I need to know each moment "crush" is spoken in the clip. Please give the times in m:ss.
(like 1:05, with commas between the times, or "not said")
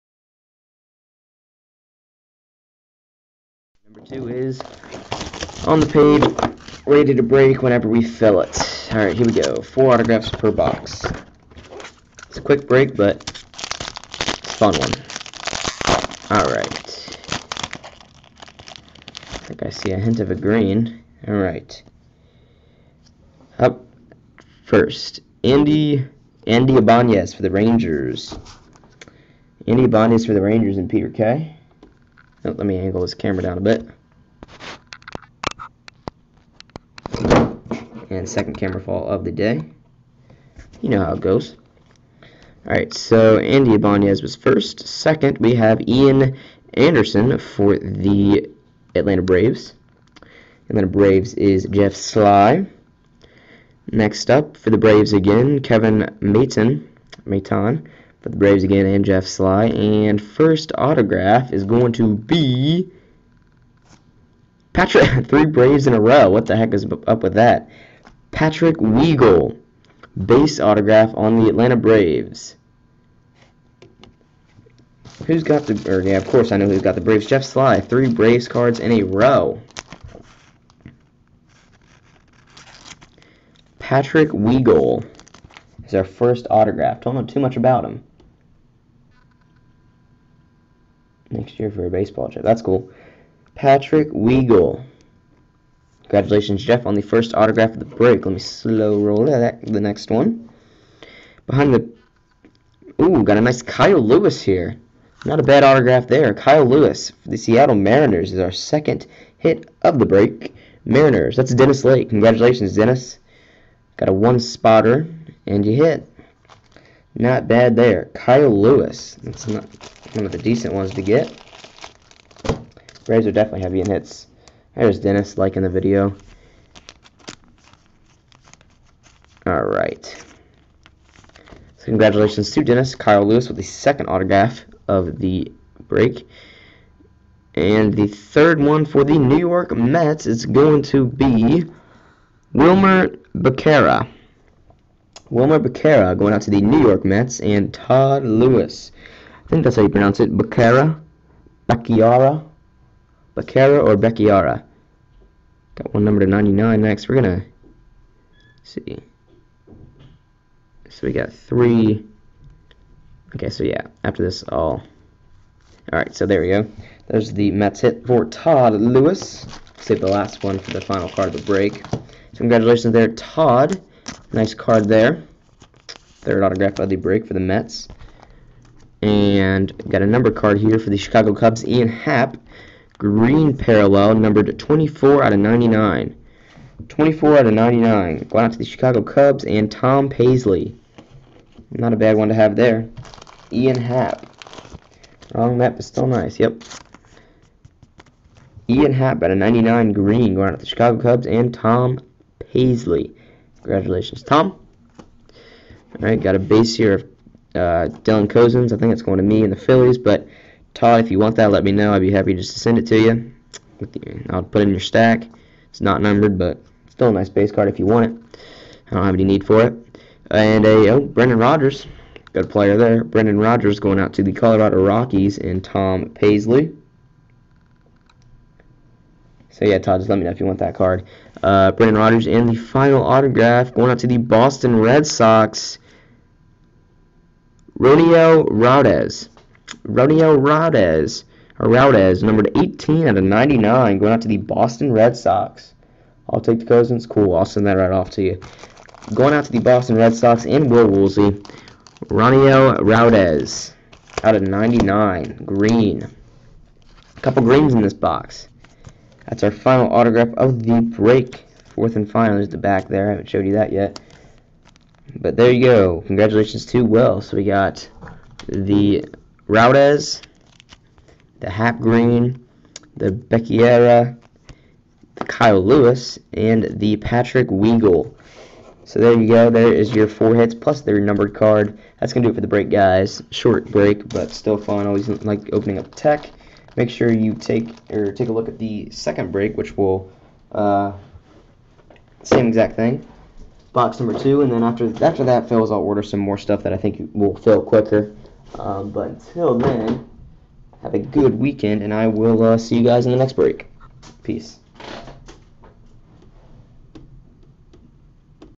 not said.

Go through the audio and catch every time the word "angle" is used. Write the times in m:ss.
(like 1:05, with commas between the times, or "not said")
0:32.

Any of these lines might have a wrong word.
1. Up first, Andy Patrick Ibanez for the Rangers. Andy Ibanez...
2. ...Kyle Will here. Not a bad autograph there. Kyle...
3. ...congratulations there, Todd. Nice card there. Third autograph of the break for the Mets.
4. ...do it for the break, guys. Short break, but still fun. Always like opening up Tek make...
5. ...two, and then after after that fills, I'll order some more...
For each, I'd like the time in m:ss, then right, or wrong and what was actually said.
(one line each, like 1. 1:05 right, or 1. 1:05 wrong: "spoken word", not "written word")
1. 0:23 wrong: "Andy", not "Patrick"
2. 1:43 wrong: "Lewis", not "Will"
3. 2:52 right
4. 4:42 right
5. 4:54 right.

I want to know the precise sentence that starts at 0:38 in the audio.
And second camera fall of the day.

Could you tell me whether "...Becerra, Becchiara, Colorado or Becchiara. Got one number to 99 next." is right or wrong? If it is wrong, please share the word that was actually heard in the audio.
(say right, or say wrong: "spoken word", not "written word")
wrong: "Becerra", not "Colorado".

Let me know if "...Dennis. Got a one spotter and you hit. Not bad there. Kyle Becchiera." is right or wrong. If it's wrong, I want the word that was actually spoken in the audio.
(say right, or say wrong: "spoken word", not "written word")
wrong: "Lewis", not "Becchiera".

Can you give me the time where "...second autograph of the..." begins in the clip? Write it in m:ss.
2:13.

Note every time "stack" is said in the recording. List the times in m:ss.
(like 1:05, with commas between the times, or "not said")
3:34.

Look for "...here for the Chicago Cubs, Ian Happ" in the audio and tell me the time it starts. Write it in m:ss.
3:00.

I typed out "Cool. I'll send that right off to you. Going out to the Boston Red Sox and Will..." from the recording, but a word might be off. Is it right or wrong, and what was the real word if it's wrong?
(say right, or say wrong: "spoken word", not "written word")
right.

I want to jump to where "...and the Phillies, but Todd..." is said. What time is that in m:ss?
3:29.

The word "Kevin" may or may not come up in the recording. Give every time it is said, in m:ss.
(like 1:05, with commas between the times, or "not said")
0:55.